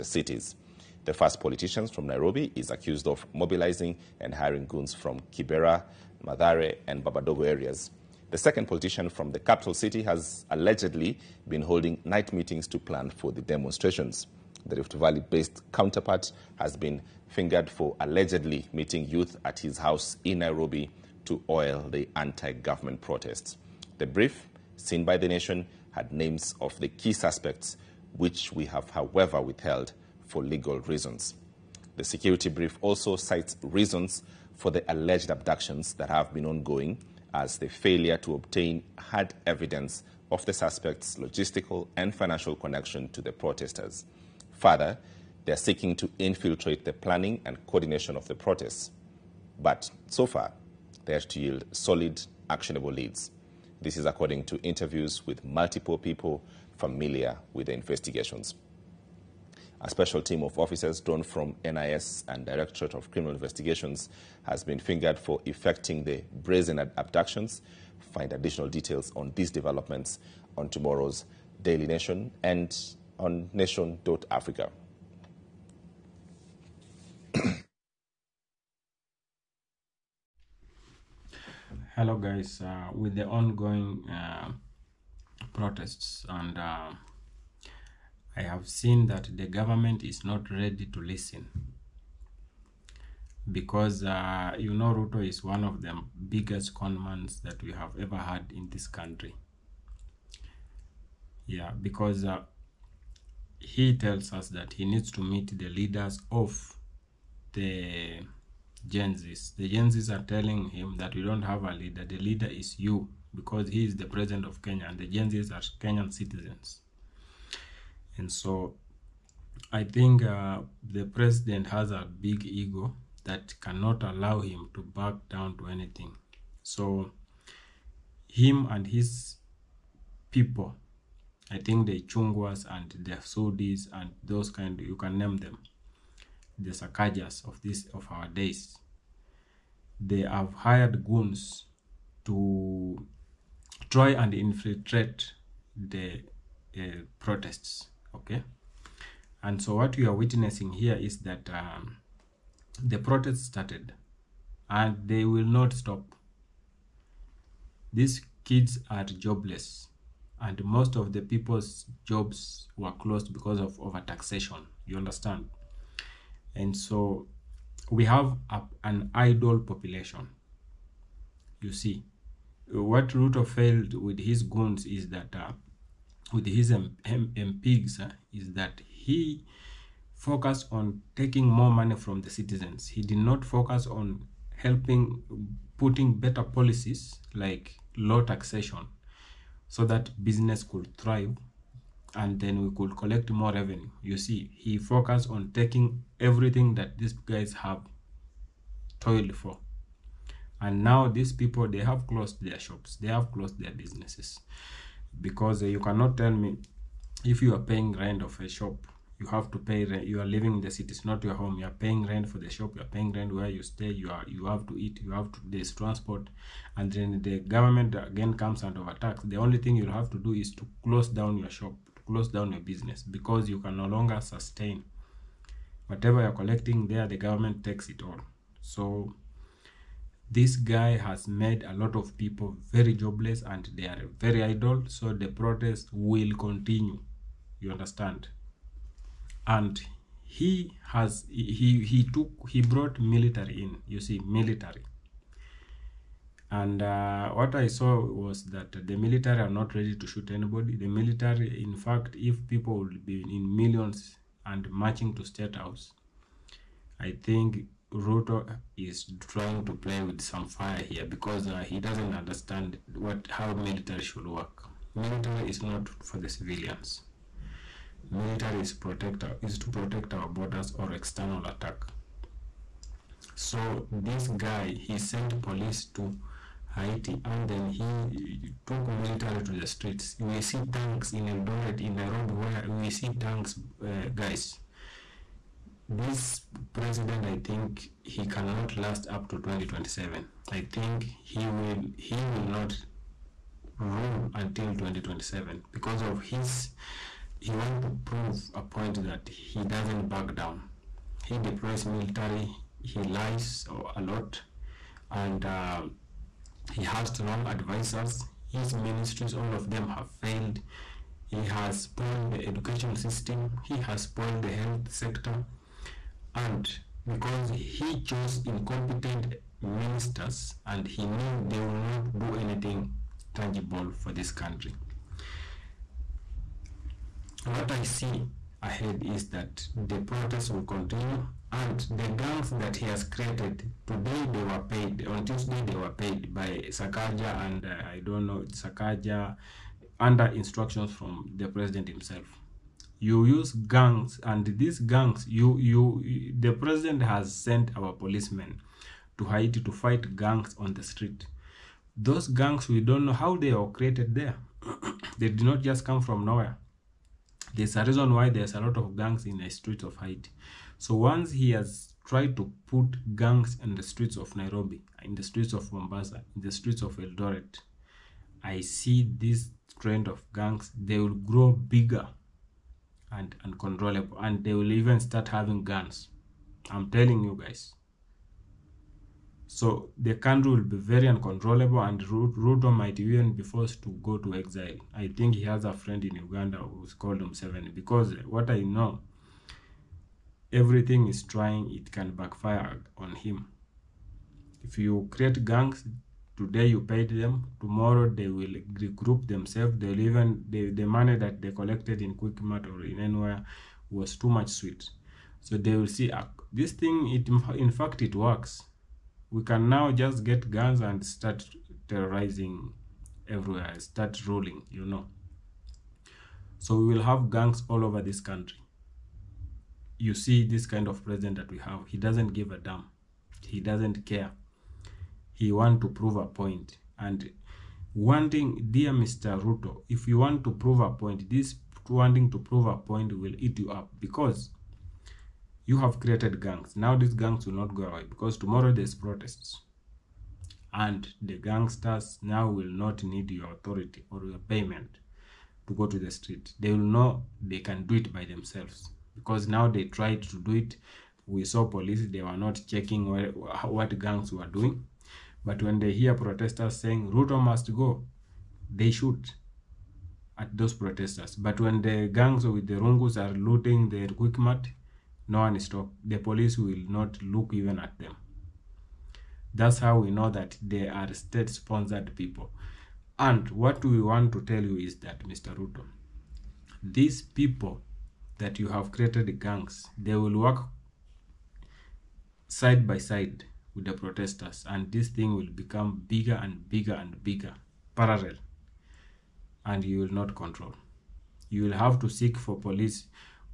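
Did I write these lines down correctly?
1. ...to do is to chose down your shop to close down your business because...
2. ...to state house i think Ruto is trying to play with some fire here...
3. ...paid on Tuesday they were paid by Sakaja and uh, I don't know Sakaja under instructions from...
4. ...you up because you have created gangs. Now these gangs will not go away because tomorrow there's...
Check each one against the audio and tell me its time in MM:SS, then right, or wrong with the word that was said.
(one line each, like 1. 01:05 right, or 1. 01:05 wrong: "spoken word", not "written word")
1. 03:40 wrong: "close", not "chose"
2. 04:15 right
3. 05:34 right
4. 07:13 right.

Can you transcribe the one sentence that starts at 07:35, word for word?
But when they hear protesters saying Ruto must go, they shoot at those protesters.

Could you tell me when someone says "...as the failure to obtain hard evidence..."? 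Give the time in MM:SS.
00:37.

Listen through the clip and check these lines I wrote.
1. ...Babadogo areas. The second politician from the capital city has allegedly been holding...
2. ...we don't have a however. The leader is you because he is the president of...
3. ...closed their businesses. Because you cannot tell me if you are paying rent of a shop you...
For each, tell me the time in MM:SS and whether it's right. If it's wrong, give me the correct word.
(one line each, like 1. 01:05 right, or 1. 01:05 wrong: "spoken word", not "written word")
1. 00:07 right
2. 01:51 wrong: "leader", not "however"
3. 03:23 right.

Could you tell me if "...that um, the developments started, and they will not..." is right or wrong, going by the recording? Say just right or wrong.
wrong.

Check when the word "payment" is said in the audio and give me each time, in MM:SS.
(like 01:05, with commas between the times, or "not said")
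07:24.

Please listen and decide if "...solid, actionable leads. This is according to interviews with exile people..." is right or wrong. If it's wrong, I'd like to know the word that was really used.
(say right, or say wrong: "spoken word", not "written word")
wrong: "multiple", not "exile".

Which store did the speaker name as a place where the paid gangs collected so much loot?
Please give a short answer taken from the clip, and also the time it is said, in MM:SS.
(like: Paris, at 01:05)
Quickmart, at 06:42.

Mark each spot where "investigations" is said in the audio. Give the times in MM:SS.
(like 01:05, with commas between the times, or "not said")
00:57, 01:03.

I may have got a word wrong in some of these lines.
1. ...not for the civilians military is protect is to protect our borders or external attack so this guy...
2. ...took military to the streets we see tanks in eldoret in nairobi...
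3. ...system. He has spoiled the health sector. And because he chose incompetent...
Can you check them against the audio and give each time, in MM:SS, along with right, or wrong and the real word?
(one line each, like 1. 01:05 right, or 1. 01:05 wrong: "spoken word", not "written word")
1. 04:25 right
2. 04:38 right
3. 05:12 right.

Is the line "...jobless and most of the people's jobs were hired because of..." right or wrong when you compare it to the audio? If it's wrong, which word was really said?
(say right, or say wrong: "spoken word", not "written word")
wrong: "closed", not "hired".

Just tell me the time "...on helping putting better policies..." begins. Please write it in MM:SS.
03:03.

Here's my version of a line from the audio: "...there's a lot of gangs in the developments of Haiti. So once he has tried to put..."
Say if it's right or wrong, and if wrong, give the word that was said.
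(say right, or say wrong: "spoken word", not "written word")
wrong: "streets", not "developments".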